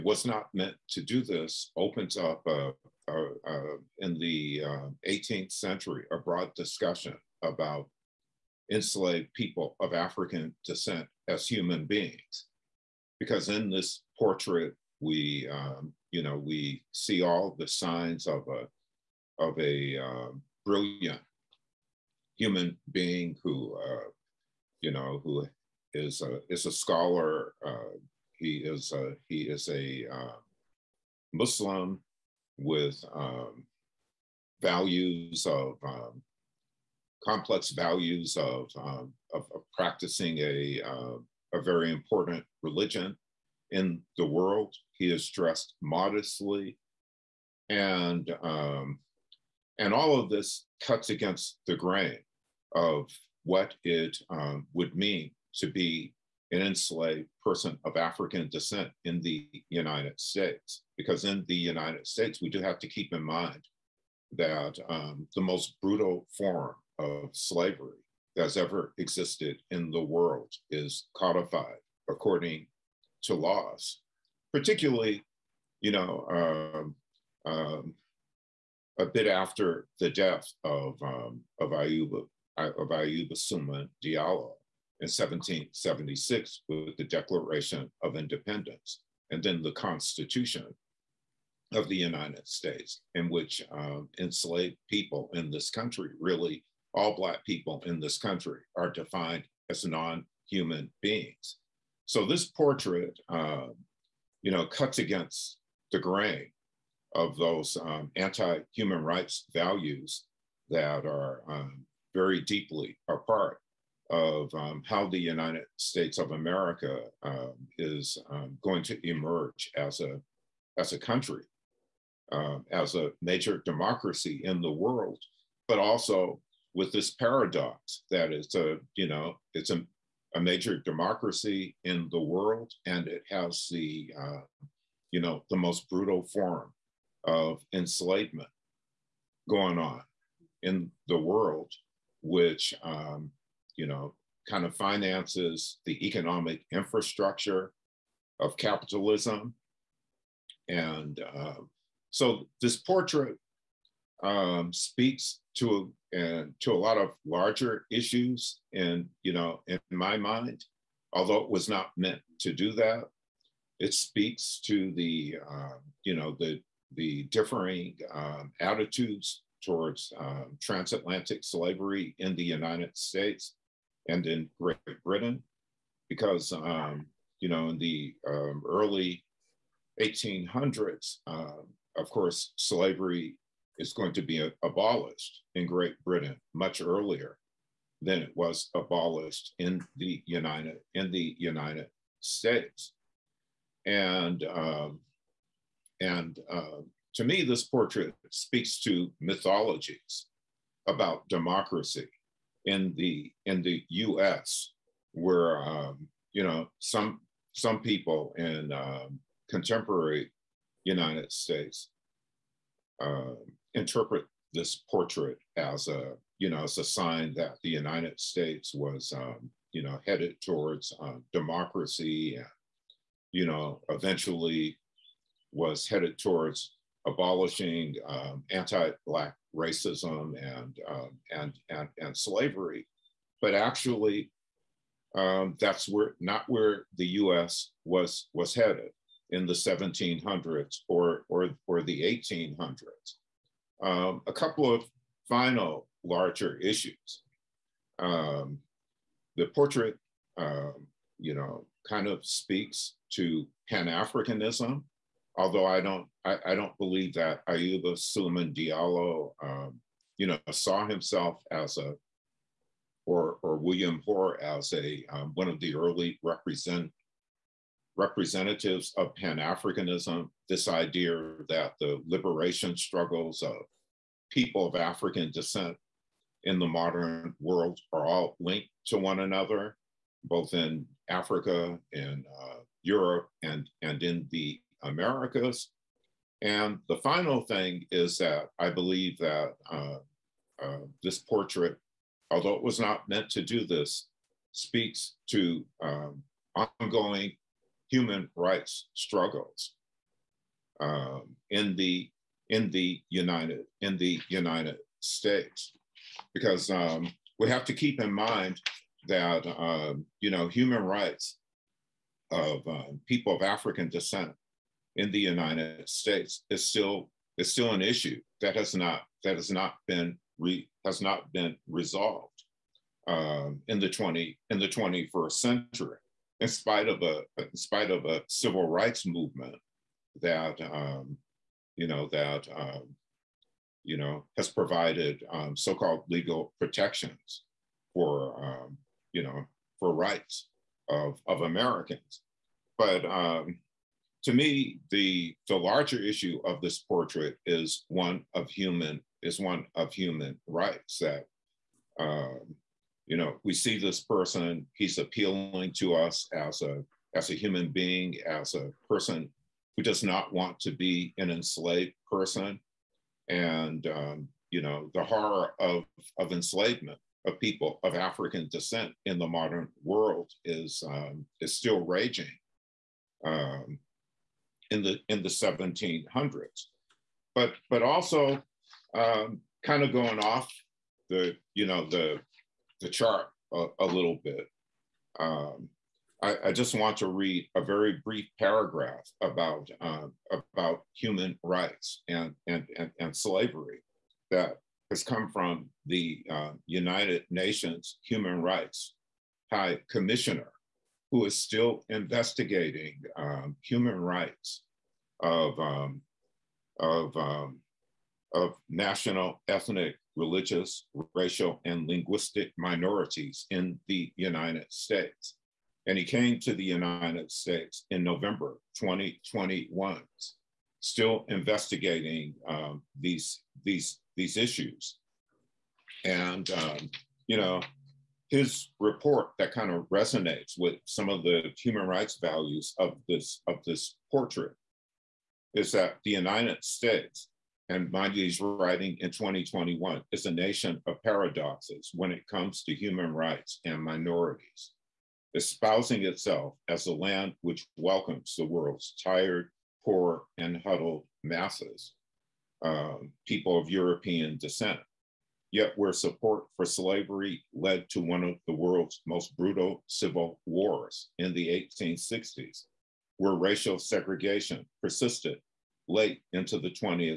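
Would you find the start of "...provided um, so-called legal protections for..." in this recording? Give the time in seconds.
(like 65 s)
334 s.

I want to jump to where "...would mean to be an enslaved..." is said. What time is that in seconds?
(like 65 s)
54 s.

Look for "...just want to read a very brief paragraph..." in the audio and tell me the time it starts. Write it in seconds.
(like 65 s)
386 s.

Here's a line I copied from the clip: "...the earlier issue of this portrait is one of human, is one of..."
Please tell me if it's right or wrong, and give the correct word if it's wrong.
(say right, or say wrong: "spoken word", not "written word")
wrong: "larger", not "earlier".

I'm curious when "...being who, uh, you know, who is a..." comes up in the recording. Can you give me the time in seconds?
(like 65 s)
22 s.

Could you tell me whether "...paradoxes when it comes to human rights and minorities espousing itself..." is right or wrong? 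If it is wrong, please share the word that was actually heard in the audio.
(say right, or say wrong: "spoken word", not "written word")
right.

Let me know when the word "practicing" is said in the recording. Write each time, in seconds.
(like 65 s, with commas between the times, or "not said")
39 s.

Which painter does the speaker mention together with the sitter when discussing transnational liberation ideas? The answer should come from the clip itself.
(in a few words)
William Hoare.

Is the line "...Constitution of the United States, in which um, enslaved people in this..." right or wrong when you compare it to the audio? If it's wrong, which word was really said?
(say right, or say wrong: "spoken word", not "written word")
right.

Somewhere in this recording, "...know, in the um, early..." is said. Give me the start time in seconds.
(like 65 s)
177 s.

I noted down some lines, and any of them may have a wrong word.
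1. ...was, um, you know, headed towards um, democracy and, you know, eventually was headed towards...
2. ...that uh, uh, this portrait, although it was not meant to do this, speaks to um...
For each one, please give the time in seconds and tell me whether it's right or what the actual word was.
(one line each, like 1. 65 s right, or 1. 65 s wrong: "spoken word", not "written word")
1. 218 s right
2. 289 s right.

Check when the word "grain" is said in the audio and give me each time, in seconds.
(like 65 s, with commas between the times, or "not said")
51 s, 106 s.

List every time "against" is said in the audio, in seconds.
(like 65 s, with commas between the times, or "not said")
51 s, 104 s.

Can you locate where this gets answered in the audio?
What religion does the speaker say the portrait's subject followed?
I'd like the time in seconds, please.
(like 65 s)
31 s.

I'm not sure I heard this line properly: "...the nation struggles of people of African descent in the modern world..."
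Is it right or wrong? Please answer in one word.
wrong.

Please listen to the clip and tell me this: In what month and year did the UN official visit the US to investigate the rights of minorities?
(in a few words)
November 2021.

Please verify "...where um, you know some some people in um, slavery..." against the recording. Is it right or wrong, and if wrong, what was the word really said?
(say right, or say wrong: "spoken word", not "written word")
wrong: "contemporary", not "slavery".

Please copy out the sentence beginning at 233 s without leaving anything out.
But actually, um, that's where not where the U.S.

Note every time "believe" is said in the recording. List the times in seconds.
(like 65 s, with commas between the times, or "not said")
256 s, 288 s.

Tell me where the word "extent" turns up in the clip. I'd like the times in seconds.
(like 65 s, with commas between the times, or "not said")
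not said.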